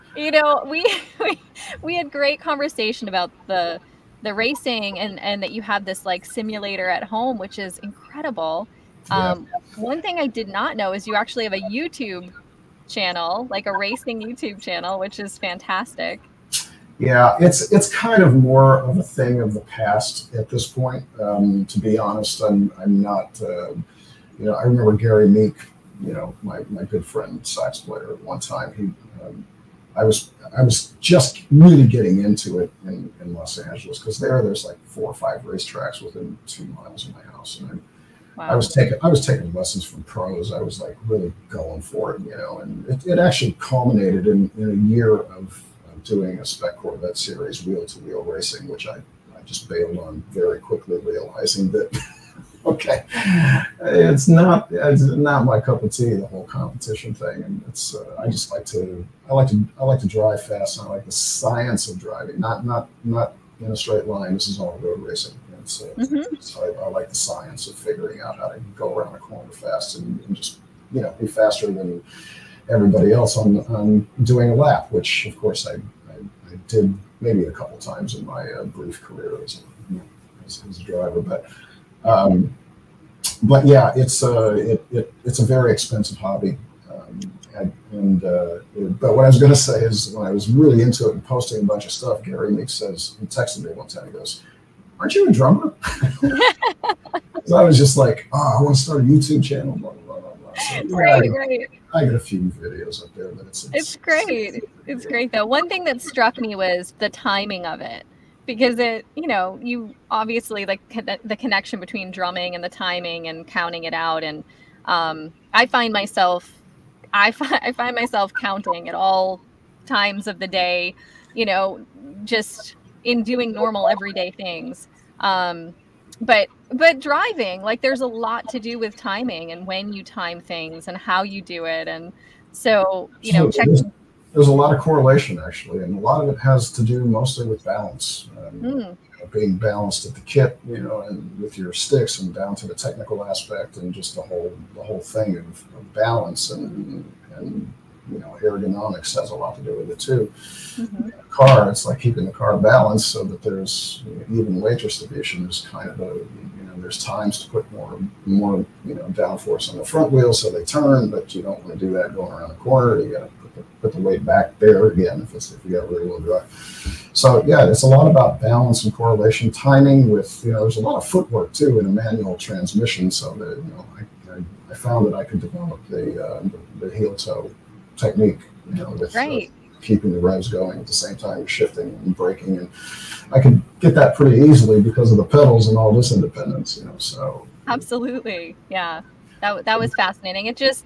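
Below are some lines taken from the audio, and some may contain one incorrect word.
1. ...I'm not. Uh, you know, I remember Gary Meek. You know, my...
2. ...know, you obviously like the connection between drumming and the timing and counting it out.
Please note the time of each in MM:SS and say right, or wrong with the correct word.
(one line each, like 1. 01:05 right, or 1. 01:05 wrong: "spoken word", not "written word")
1. 00:22 right
2. 01:49 right.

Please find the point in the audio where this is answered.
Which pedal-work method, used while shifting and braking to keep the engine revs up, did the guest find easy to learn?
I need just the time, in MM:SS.
02:56.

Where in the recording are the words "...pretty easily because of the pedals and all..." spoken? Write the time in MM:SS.
03:04.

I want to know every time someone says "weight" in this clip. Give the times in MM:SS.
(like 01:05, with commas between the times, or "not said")
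02:34, 02:43.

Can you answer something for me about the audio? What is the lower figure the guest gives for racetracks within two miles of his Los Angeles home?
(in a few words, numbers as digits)
4.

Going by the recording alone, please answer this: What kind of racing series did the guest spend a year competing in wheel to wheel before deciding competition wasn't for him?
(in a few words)
Spec Corvette series.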